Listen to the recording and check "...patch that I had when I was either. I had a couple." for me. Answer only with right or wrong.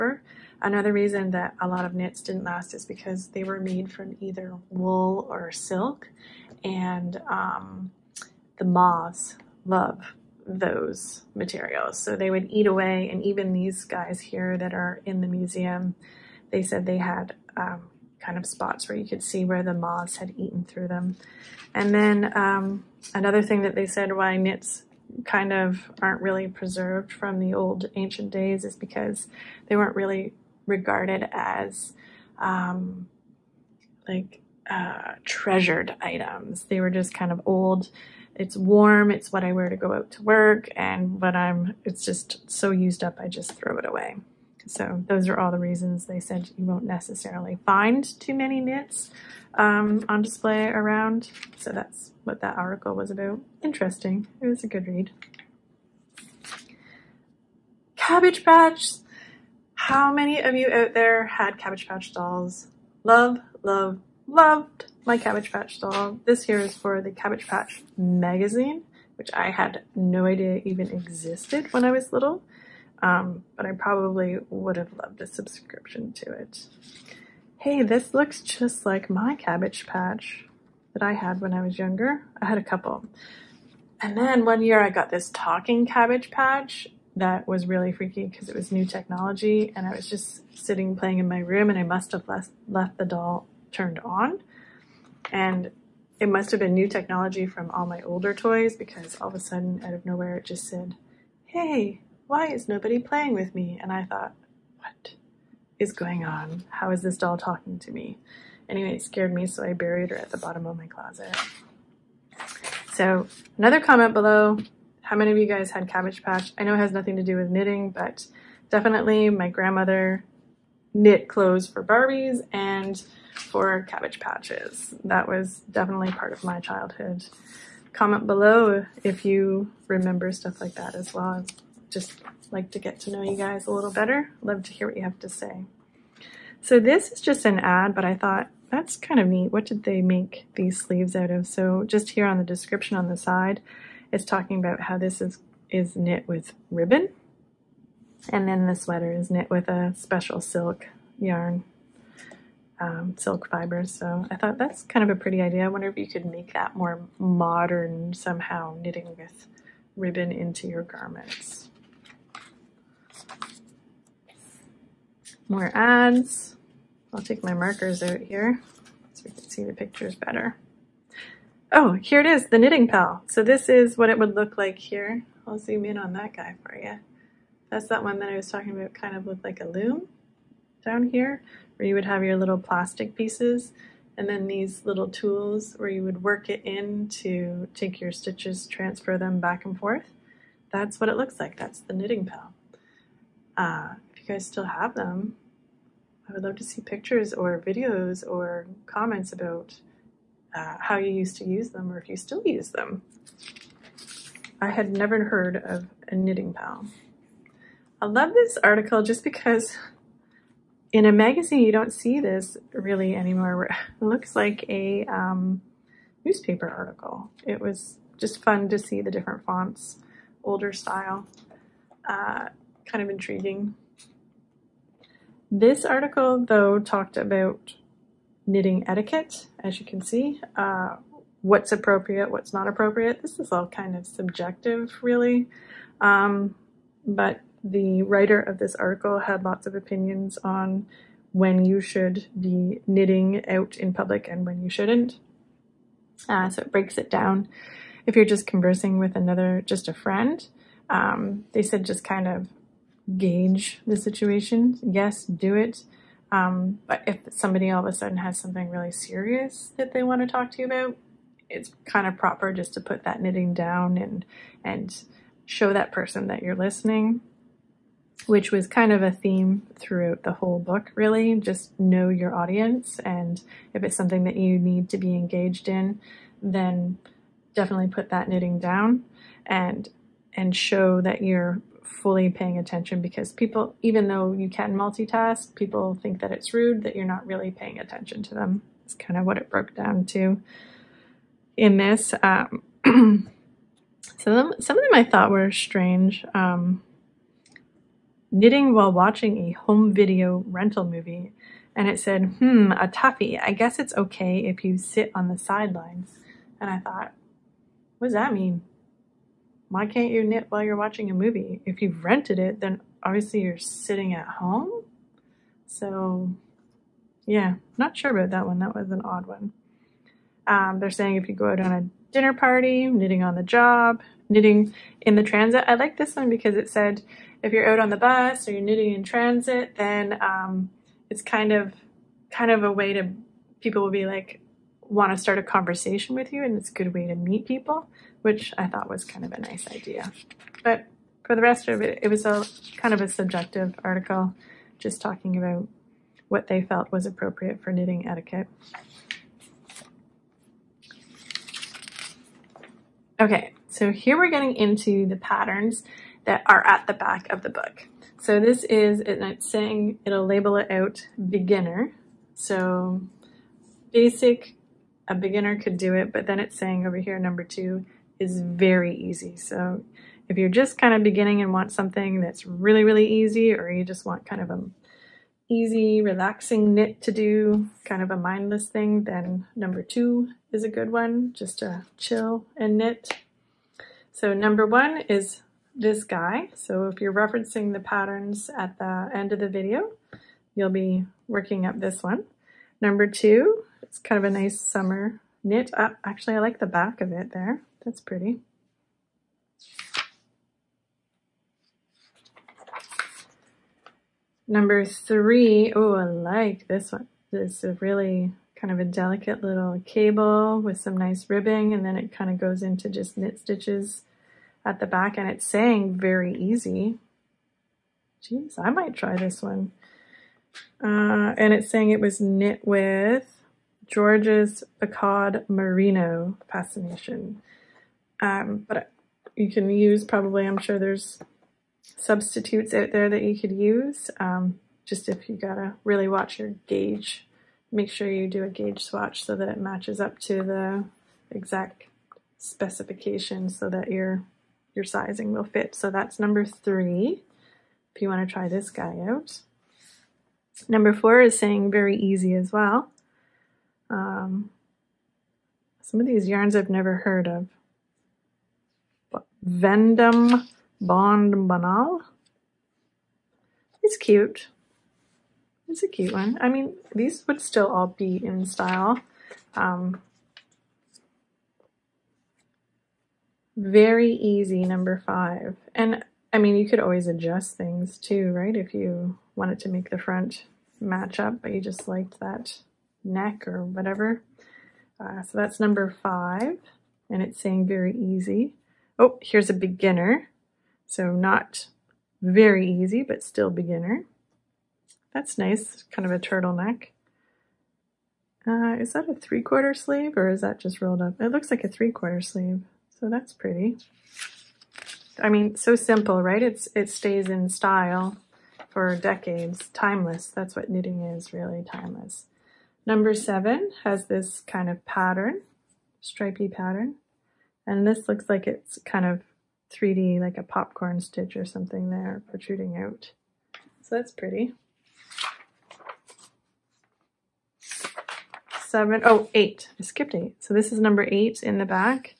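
wrong.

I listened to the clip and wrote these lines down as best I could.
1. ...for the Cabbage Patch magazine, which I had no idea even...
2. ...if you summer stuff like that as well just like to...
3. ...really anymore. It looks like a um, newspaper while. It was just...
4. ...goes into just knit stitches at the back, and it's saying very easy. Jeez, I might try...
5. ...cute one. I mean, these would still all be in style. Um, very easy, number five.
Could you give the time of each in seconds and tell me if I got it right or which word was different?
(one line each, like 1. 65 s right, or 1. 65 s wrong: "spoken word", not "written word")
1. 66 s right
2. 129 s wrong: "remember", not "summer"
3. 212 s wrong: "article", not "while"
4. 412 s right
5. 465 s right.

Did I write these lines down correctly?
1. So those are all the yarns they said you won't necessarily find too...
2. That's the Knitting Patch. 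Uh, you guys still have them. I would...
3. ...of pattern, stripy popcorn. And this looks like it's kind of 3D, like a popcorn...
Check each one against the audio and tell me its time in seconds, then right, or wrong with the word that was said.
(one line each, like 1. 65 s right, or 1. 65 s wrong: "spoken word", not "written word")
1. 44 s wrong: "reasons", not "yarns"
2. 191 s wrong: "Pal", not "Patch"
3. 514 s wrong: "pattern", not "popcorn".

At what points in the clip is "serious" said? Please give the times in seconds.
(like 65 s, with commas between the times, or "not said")
258 s.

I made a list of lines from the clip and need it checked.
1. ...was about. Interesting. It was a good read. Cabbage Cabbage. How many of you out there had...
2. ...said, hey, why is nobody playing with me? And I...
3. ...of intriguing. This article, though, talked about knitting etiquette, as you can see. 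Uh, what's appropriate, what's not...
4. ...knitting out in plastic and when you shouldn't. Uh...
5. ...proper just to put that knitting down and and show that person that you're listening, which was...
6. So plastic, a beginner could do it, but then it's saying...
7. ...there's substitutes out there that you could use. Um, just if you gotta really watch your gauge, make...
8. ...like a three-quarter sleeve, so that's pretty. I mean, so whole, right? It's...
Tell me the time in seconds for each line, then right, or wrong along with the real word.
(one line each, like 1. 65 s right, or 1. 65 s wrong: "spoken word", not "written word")
1. 52 s wrong: "Patch", not "Cabbage"
2. 100 s right
3. 223 s right
4. 242 s wrong: "public", not "plastic"
5. 262 s right
6. 362 s wrong: "basic", not "plastic"
7. 430 s right
8. 501 s wrong: "simple", not "whole".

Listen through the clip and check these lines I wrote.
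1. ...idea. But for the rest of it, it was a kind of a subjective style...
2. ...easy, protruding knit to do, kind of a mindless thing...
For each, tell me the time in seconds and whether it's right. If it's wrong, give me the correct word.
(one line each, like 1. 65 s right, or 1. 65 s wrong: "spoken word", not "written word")
1. 339 s wrong: "article", not "style"
2. 375 s wrong: "relaxing", not "protruding".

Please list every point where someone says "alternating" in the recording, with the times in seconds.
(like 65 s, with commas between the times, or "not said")
not said.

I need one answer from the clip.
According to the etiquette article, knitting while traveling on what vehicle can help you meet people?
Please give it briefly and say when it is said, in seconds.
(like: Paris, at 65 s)
bus, at 327 s.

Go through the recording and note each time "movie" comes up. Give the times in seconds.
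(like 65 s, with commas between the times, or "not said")
300 s, 311 s.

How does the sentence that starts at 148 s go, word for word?
And then the sweater is knit with a special silk yarn, um, silk fibers.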